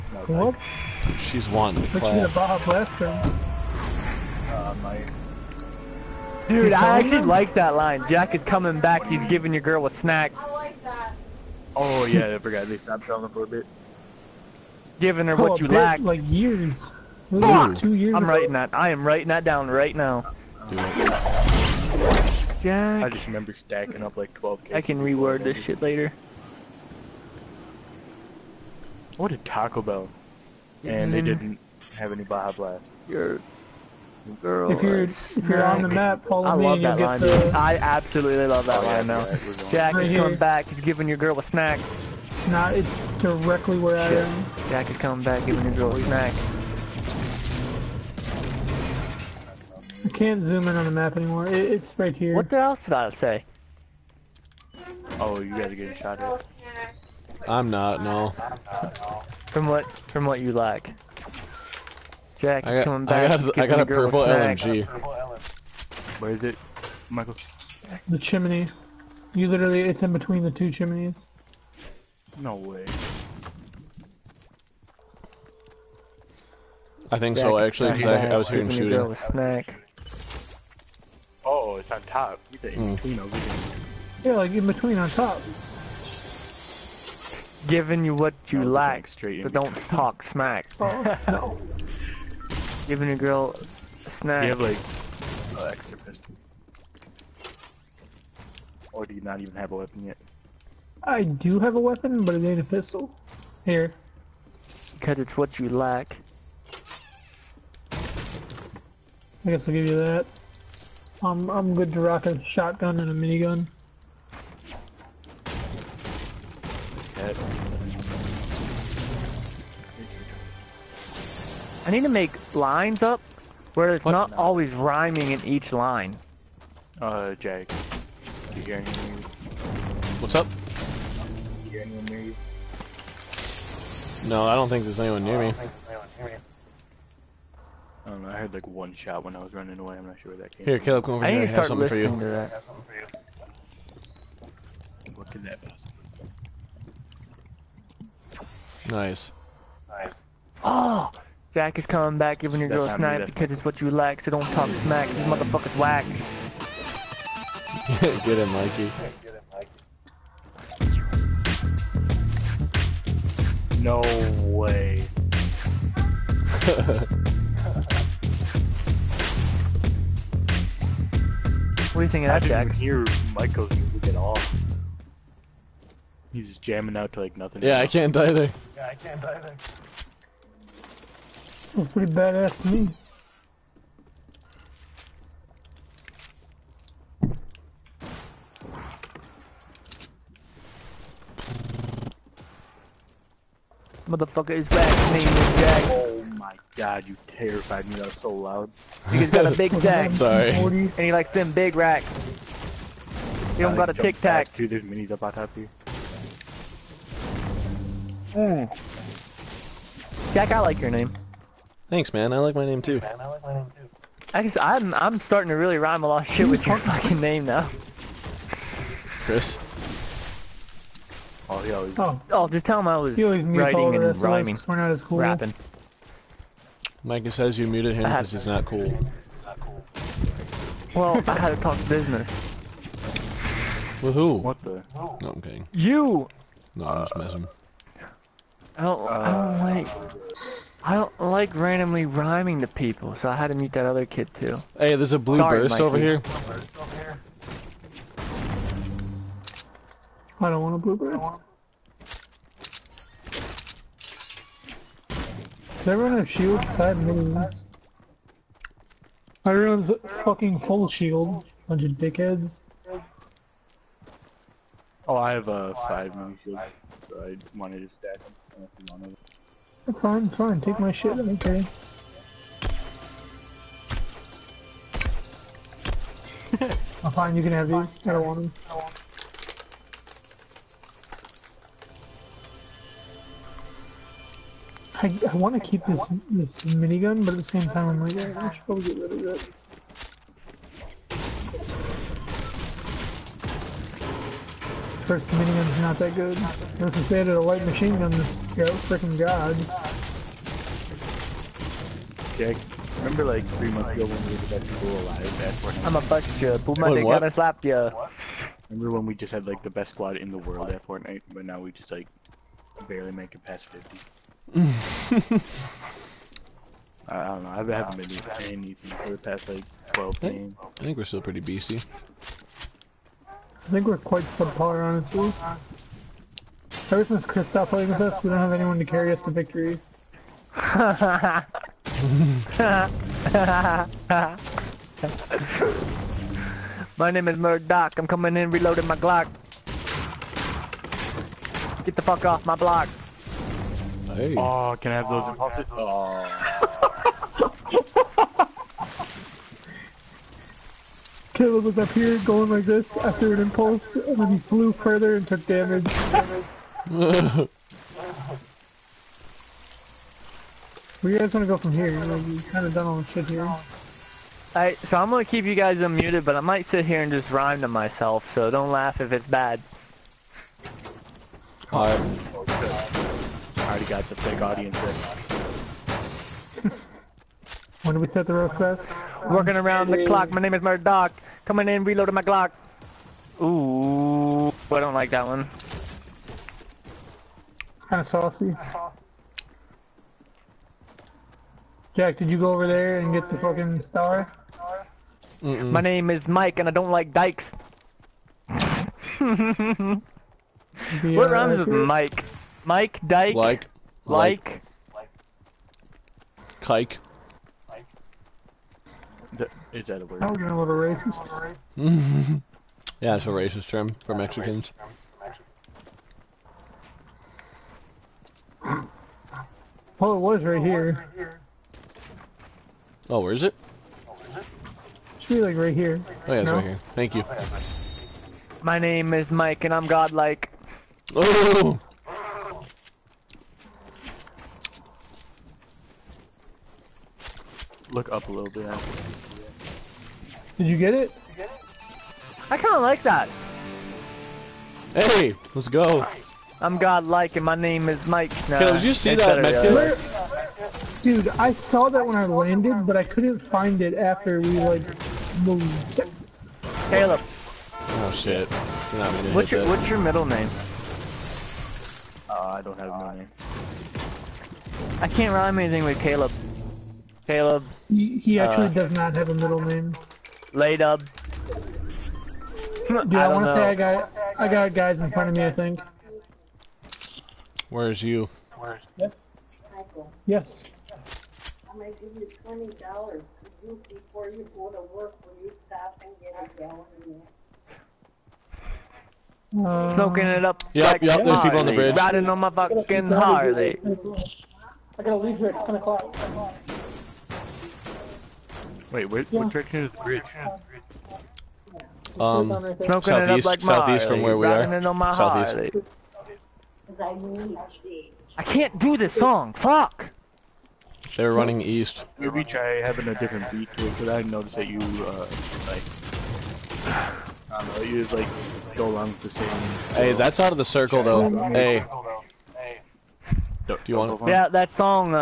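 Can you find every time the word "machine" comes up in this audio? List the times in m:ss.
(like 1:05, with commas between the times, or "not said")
4:57.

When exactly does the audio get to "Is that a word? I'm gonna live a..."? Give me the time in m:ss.
6:49.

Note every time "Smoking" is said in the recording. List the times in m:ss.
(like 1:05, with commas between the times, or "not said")
8:09, 8:22.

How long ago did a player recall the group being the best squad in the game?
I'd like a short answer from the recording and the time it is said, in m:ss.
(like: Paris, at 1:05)
Three months, at 5:03.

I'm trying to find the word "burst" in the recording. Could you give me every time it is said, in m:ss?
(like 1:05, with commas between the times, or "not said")
4:05, 4:10.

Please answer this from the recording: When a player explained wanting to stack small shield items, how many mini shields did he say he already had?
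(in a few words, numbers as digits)
5.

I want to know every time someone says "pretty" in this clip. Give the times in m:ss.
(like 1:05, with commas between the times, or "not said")
3:01, 5:21.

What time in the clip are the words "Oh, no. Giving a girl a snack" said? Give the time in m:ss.
1:30.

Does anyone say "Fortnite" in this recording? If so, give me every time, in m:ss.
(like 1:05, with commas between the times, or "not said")
5:10.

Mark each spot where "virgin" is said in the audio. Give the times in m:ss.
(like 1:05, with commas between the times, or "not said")
not said.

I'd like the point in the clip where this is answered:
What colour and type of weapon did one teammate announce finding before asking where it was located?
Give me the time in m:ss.
1:03.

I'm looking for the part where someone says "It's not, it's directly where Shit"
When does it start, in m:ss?
0:42.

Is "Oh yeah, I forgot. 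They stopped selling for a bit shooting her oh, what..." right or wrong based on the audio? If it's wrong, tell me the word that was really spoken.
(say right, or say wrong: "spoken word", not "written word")
wrong: "giving", not "shooting".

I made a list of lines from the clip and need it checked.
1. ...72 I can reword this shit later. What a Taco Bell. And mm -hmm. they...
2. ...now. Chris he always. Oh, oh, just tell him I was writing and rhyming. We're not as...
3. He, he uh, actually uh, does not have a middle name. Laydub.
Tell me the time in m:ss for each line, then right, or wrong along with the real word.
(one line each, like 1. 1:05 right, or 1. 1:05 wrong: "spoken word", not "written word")
1. 0:24 wrong: "12", not "72"
2. 3:37 right
3. 7:47 right.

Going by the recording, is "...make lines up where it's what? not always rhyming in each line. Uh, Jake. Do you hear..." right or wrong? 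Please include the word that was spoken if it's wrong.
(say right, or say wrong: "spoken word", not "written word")
right.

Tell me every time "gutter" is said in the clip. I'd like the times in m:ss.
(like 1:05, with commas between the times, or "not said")
not said.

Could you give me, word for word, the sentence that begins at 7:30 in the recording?
Uh, dude, I saw that when I landed, but I couldn't find it after we like moved.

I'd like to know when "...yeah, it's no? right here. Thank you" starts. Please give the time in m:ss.
7:06.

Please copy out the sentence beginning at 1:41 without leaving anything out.
I do have a weapon, but it ain't a pistol.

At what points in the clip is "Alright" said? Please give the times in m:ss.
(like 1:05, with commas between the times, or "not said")
6:04, 6:11.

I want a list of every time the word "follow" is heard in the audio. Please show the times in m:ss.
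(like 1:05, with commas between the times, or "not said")
0:36.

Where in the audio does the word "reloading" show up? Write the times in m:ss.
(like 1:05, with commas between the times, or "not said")
5:38, 6:21.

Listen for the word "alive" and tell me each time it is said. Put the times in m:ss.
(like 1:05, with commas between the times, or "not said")
5:04.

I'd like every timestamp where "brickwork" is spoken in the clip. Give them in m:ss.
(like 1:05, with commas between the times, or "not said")
not said.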